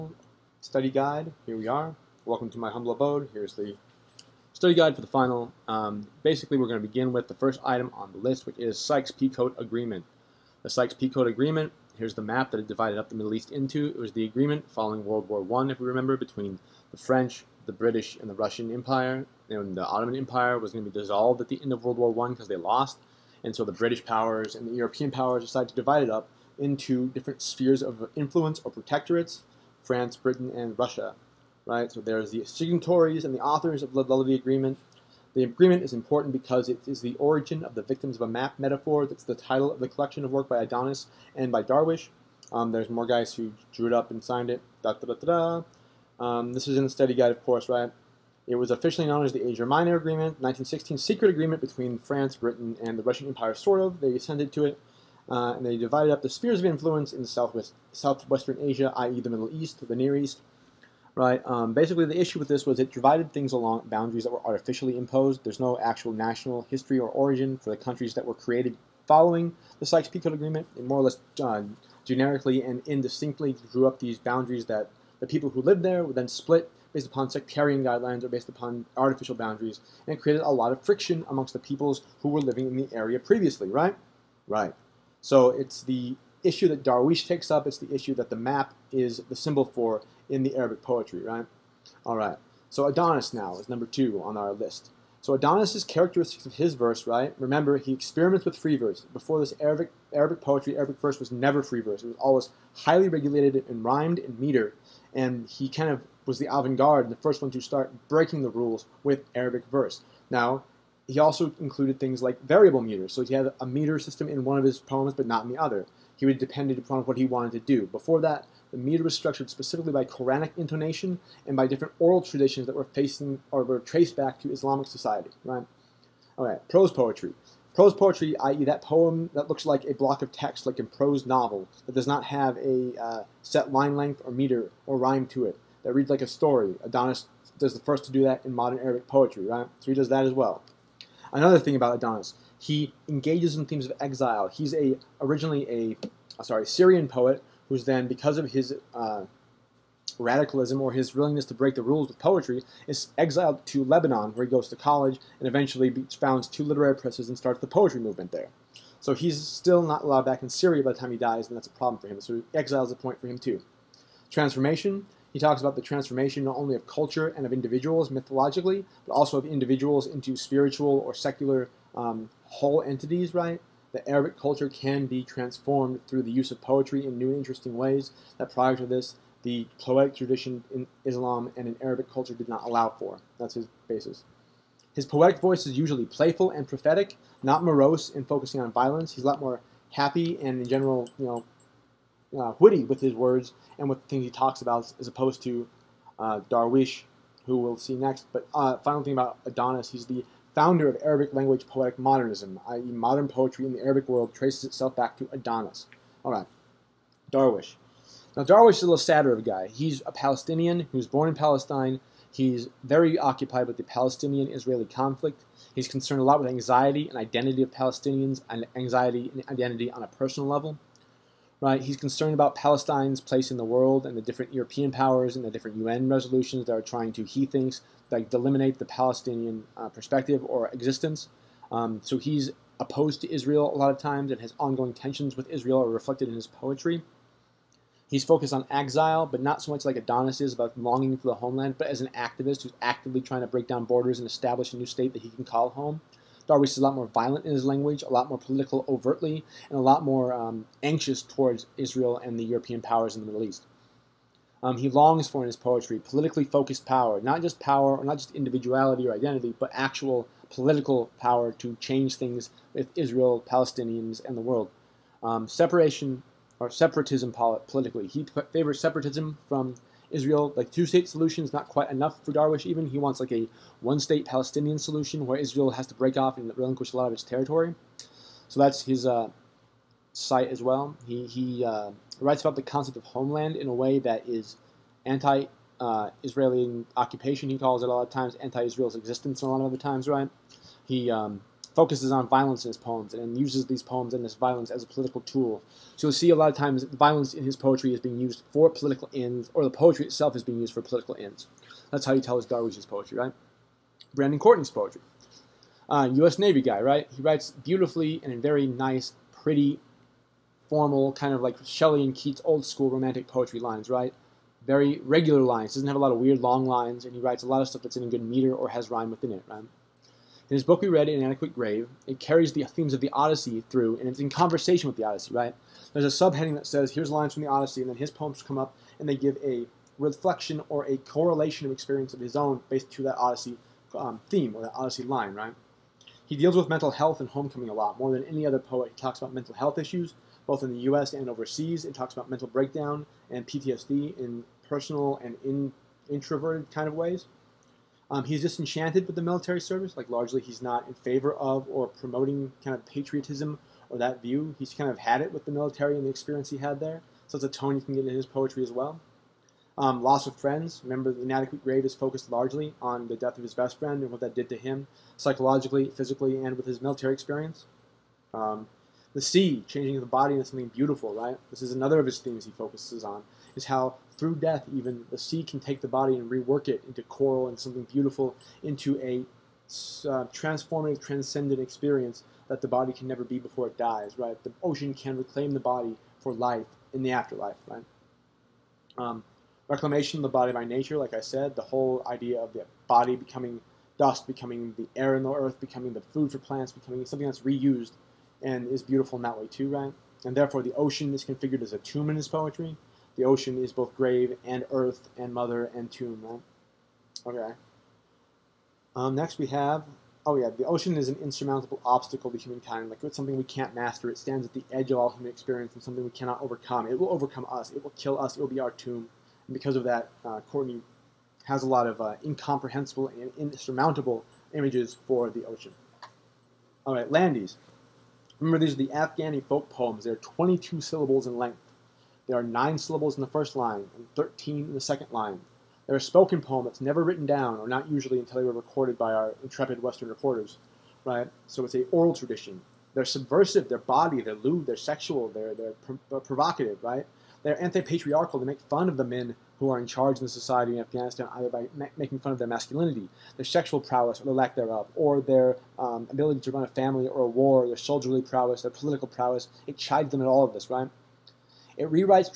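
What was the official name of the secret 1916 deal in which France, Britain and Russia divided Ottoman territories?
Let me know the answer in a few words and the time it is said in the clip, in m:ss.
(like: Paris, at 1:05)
Asia Minor Agreement, at 0:49.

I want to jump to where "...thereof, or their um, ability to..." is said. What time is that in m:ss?
7:34.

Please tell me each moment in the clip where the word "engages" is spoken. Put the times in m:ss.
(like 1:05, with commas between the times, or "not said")
2:23.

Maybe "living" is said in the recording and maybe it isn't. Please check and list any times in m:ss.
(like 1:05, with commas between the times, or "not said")
1:22.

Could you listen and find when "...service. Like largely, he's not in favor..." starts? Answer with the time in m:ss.
5:49.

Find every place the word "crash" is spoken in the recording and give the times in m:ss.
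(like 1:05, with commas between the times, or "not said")
not said.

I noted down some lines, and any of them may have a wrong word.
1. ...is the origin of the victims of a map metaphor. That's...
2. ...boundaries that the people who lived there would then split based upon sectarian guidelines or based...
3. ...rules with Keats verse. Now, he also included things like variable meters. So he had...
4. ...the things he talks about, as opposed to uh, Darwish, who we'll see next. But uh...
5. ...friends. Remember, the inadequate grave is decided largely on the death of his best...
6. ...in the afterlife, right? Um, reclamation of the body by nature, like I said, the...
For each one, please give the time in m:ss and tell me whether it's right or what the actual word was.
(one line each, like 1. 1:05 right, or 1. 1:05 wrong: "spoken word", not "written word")
1. 0:36 right
2. 1:14 right
3. 1:48 wrong: "Arabic", not "Keats"
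4. 3:14 right
5. 6:00 wrong: "focused", not "decided"
6. 6:26 right.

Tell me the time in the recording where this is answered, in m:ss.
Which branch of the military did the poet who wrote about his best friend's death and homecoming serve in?
5:06.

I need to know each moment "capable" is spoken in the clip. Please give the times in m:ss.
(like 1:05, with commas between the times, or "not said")
not said.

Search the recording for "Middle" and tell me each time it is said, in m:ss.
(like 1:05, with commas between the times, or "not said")
0:13, 0:59, 4:13.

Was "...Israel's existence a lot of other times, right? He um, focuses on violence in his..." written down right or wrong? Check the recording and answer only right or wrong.
right.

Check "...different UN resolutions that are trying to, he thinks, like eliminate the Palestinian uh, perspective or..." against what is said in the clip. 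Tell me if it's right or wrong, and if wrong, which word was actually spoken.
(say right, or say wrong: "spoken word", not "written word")
right.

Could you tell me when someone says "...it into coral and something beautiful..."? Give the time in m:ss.
6:16.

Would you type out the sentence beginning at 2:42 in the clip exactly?
So exile is a point for him too.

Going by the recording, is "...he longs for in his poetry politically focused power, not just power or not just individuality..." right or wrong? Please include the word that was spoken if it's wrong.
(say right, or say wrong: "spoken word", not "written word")
right.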